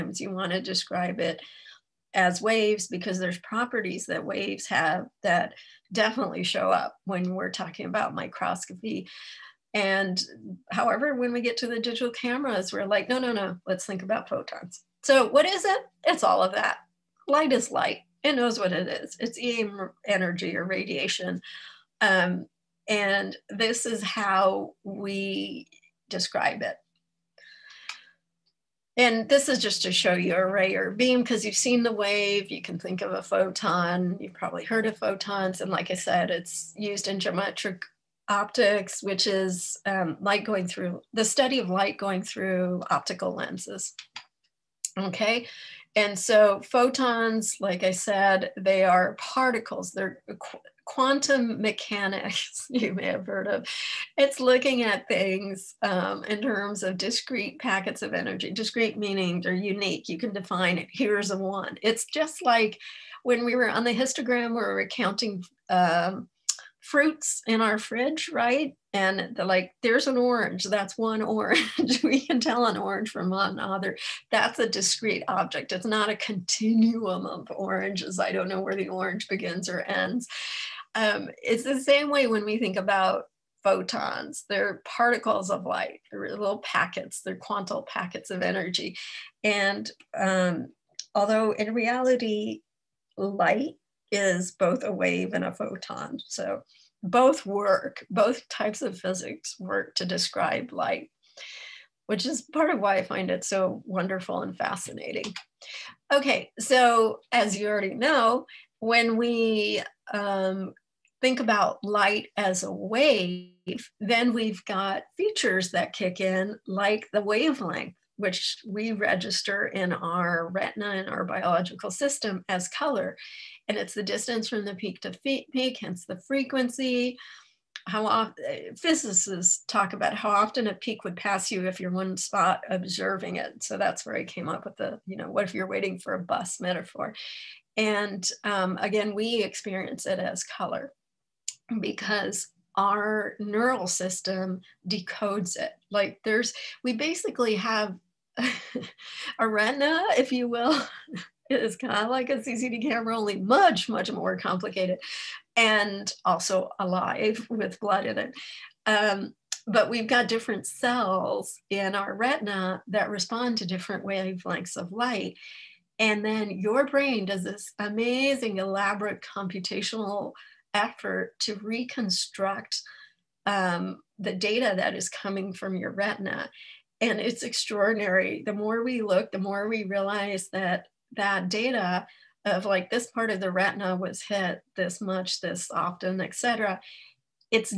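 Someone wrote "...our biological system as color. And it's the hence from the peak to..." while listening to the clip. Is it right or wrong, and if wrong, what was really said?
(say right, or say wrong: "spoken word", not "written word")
wrong: "distance", not "hence".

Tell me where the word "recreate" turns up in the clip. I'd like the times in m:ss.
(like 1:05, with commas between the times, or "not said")
not said.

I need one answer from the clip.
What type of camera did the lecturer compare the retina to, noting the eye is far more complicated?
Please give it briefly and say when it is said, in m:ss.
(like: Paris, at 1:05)
CCD camera, at 2:32.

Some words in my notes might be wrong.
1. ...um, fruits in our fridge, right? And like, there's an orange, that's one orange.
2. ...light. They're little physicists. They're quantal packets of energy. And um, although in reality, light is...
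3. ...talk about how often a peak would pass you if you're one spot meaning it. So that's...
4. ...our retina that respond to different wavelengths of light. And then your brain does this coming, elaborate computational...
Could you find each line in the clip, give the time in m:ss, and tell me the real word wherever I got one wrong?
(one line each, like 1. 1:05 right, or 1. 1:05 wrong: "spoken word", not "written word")
1. 1:05 right
2. 1:25 wrong: "packets", not "physicists"
3. 2:09 wrong: "observing", not "meaning"
4. 2:41 wrong: "amazing", not "coming".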